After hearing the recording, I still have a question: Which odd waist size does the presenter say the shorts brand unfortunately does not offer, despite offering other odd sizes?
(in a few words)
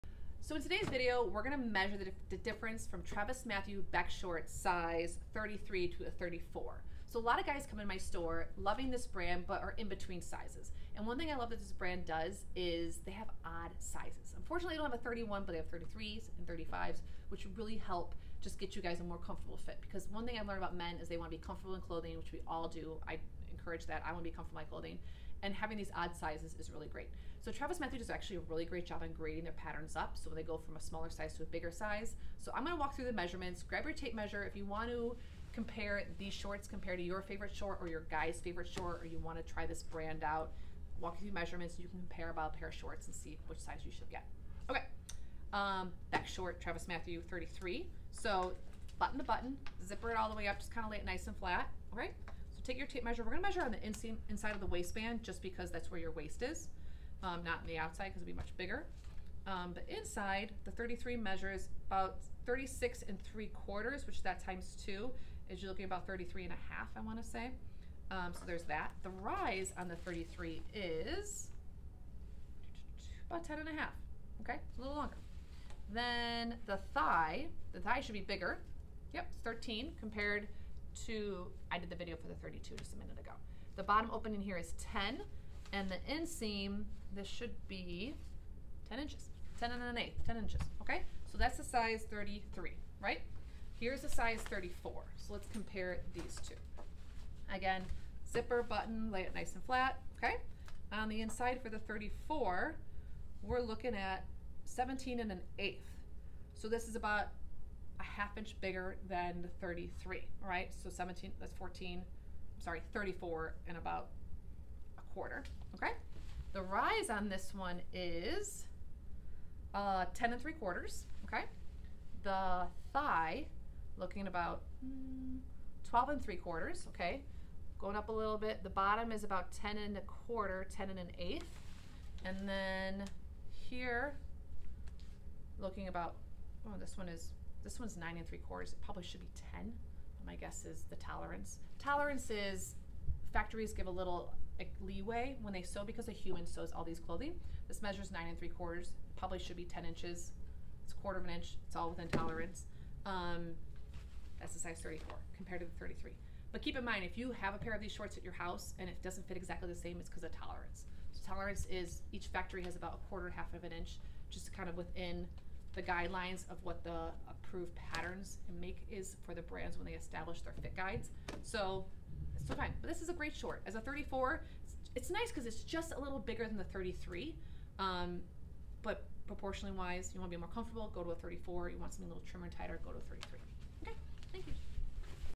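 31.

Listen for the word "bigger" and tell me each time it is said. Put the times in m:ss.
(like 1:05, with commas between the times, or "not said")
0:31, 0:58, 1:18, 1:48, 2:56.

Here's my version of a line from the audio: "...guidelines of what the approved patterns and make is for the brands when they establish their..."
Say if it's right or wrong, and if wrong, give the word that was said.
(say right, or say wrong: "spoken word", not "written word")
right.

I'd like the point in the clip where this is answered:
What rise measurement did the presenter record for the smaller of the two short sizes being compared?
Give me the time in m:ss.
1:13.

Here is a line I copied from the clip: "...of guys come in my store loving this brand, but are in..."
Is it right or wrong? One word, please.
right.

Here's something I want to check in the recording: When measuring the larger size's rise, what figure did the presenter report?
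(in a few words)
10 and 3 quarters.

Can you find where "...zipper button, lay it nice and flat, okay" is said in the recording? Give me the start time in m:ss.
1:38.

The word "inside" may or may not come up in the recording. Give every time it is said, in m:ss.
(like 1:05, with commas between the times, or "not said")
0:54, 0:59, 1:41.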